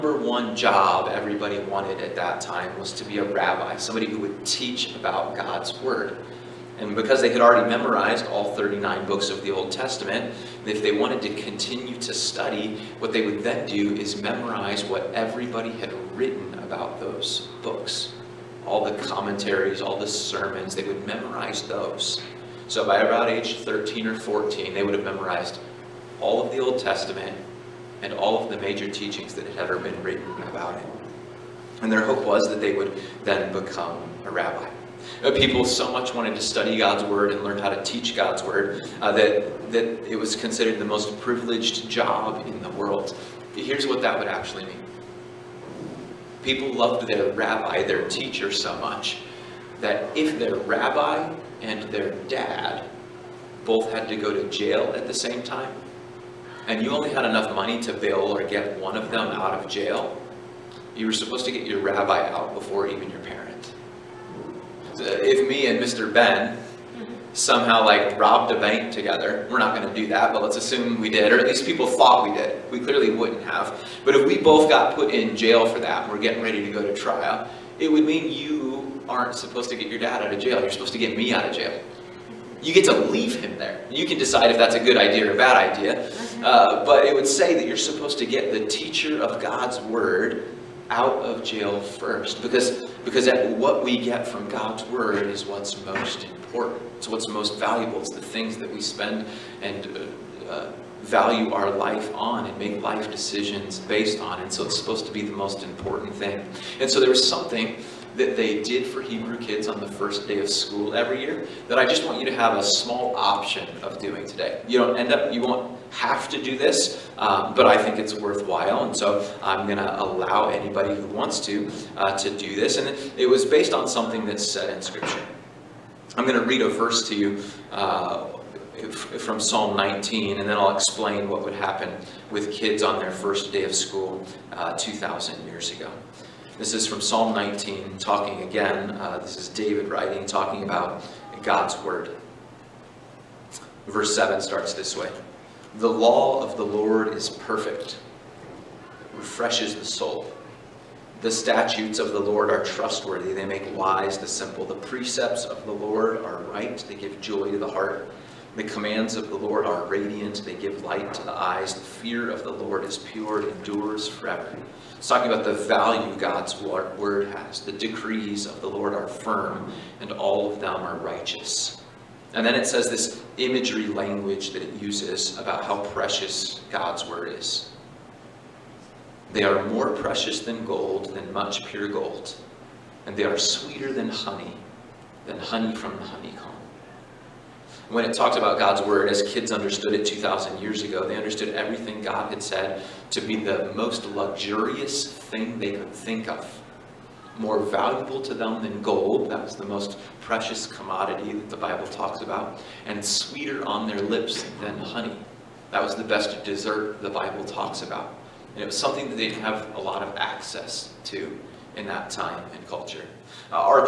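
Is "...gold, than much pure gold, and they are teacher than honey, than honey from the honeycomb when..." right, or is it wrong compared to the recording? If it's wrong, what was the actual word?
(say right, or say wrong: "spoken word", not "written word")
wrong: "sweeter", not "teacher".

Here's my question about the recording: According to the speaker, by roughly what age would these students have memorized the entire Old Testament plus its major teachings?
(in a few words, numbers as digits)
13 or 14.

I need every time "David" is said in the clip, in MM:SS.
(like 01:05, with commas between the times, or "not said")
02:19.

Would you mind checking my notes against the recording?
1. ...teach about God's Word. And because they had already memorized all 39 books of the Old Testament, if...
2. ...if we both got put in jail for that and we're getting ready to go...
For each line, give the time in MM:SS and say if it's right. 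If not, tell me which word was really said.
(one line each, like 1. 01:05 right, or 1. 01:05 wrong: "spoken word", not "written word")
1. 00:04 right
2. 01:14 right.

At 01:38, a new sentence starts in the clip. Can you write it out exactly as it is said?
It's the things that we spend and uh, uh, value our life on and make life decisions based on.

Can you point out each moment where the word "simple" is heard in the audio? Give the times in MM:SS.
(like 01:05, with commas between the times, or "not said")
02:34.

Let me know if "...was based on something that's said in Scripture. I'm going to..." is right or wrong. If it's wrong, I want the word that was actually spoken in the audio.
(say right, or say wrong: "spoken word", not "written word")
right.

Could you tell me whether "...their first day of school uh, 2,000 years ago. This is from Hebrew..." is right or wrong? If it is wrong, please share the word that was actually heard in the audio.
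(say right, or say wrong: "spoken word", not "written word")
wrong: "Psalm", not "Hebrew".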